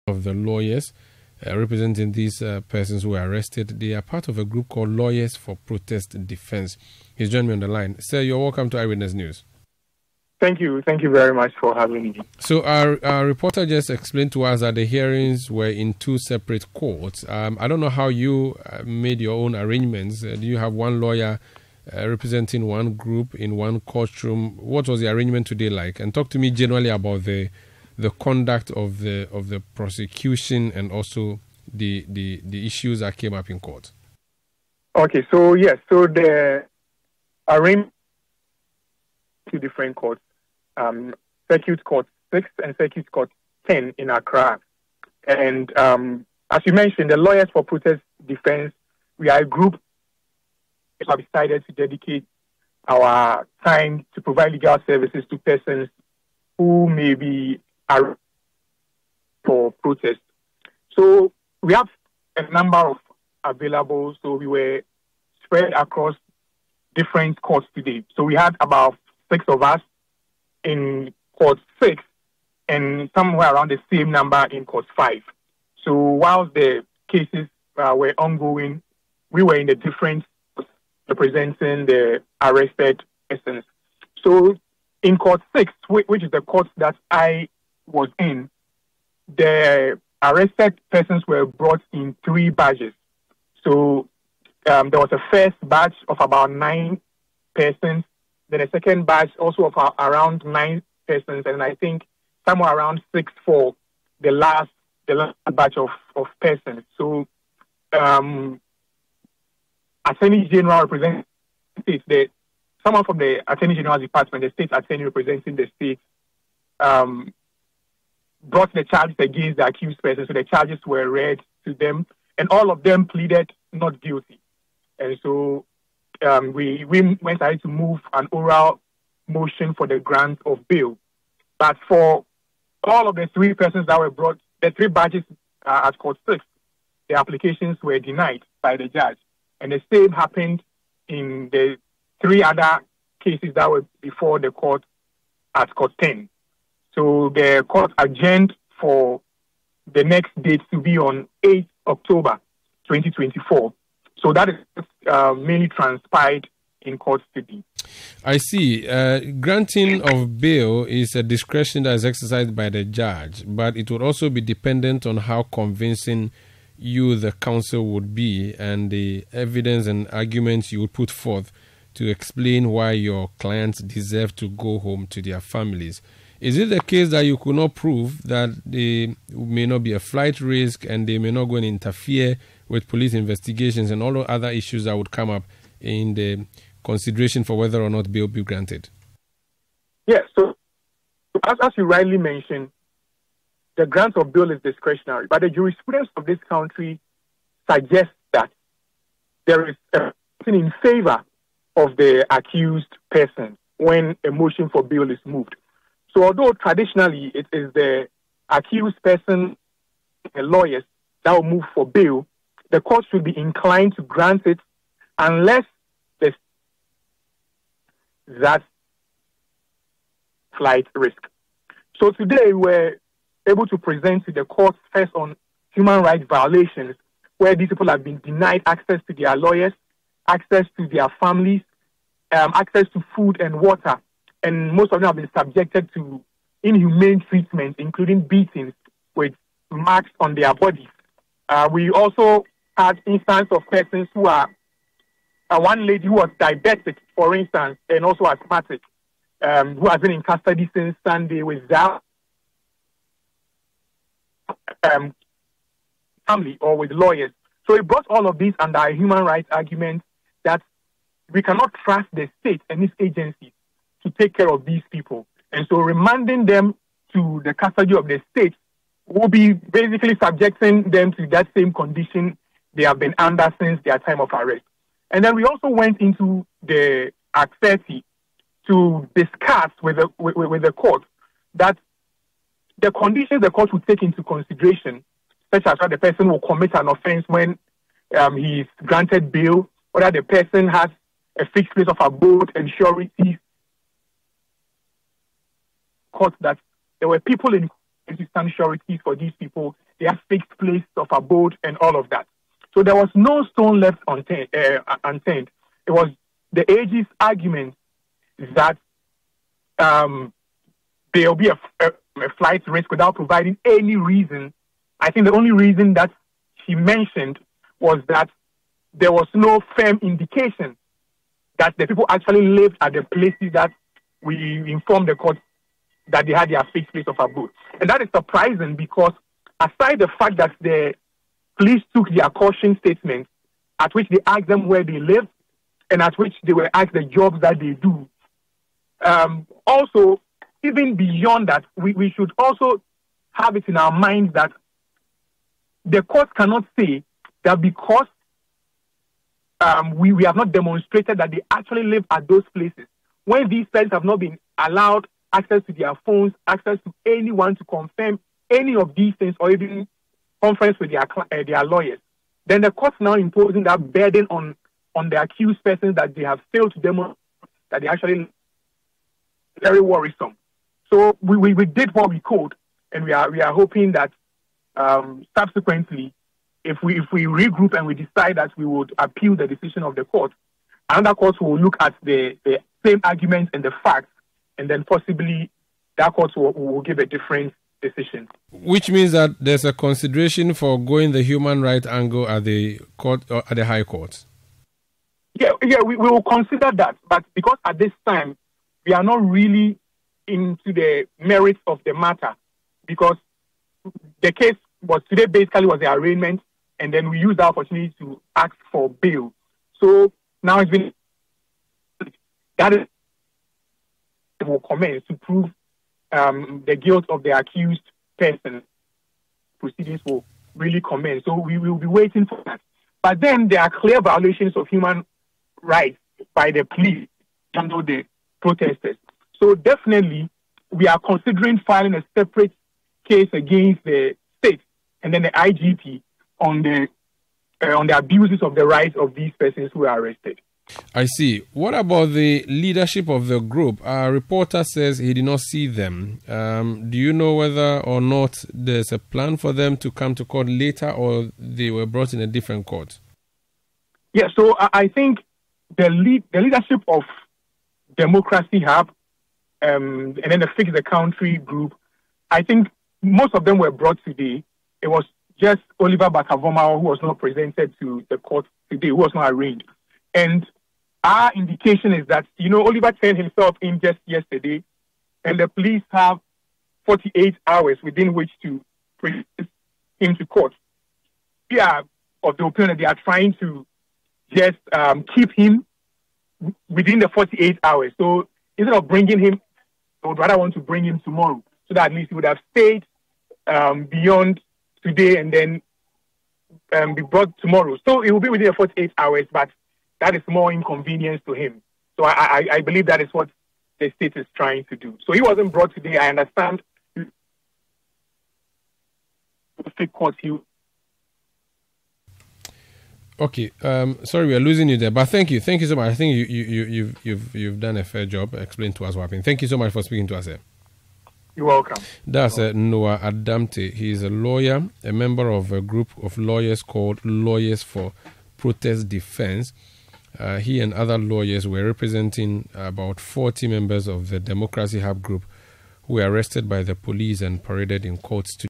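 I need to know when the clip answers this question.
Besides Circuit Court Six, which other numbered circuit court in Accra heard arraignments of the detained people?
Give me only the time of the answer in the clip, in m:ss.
0:42.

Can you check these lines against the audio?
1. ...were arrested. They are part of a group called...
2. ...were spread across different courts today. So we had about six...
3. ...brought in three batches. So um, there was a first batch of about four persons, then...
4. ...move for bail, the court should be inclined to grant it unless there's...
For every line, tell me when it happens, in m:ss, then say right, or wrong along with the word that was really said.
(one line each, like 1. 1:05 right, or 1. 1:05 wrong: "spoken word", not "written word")
1. 0:03 right
2. 1:04 right
3. 1:31 wrong: "nine", not "four"
4. 3:31 right.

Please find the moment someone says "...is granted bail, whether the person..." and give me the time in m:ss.
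4:48.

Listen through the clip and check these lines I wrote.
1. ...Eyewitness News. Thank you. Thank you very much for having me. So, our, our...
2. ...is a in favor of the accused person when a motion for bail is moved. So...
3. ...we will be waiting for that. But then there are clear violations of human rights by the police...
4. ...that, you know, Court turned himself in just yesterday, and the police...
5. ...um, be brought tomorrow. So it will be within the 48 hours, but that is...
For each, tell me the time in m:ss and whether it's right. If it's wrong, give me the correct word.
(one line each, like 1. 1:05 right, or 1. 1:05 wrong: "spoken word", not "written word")
1. 0:08 right
2. 3:19 right
3. 7:01 right
4. 7:52 wrong: "Oliver", not "Court"
5. 8:16 right.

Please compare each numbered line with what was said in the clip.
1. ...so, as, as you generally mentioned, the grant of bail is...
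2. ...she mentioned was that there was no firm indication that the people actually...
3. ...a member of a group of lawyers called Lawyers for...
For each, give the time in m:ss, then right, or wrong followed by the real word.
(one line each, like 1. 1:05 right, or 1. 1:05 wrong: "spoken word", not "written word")
1. 3:10 wrong: "rightly", not "generally"
2. 5:16 right
3. 8:44 right.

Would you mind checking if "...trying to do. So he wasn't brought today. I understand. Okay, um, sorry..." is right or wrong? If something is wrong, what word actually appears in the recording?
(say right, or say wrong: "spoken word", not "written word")
right.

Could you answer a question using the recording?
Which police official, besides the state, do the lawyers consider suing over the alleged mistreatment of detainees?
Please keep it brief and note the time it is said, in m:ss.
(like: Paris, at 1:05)
the IGP, at 7:15.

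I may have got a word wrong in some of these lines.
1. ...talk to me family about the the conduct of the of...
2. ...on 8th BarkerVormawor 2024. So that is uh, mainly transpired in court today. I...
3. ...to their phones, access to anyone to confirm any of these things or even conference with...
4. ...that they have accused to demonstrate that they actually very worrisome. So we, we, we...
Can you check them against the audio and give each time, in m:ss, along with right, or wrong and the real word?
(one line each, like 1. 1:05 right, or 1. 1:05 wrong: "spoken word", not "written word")
1. 0:26 wrong: "generally", not "family"
2. 2:30 wrong: "October", not "BarkerVormawor"
3. 5:55 right
4. 6:05 wrong: "failed", not "accused".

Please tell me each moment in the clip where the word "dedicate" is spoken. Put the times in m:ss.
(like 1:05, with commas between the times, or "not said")
0:51.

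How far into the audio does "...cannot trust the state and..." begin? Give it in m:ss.
4:21.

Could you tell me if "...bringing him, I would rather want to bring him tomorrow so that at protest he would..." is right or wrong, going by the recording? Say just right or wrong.
wrong.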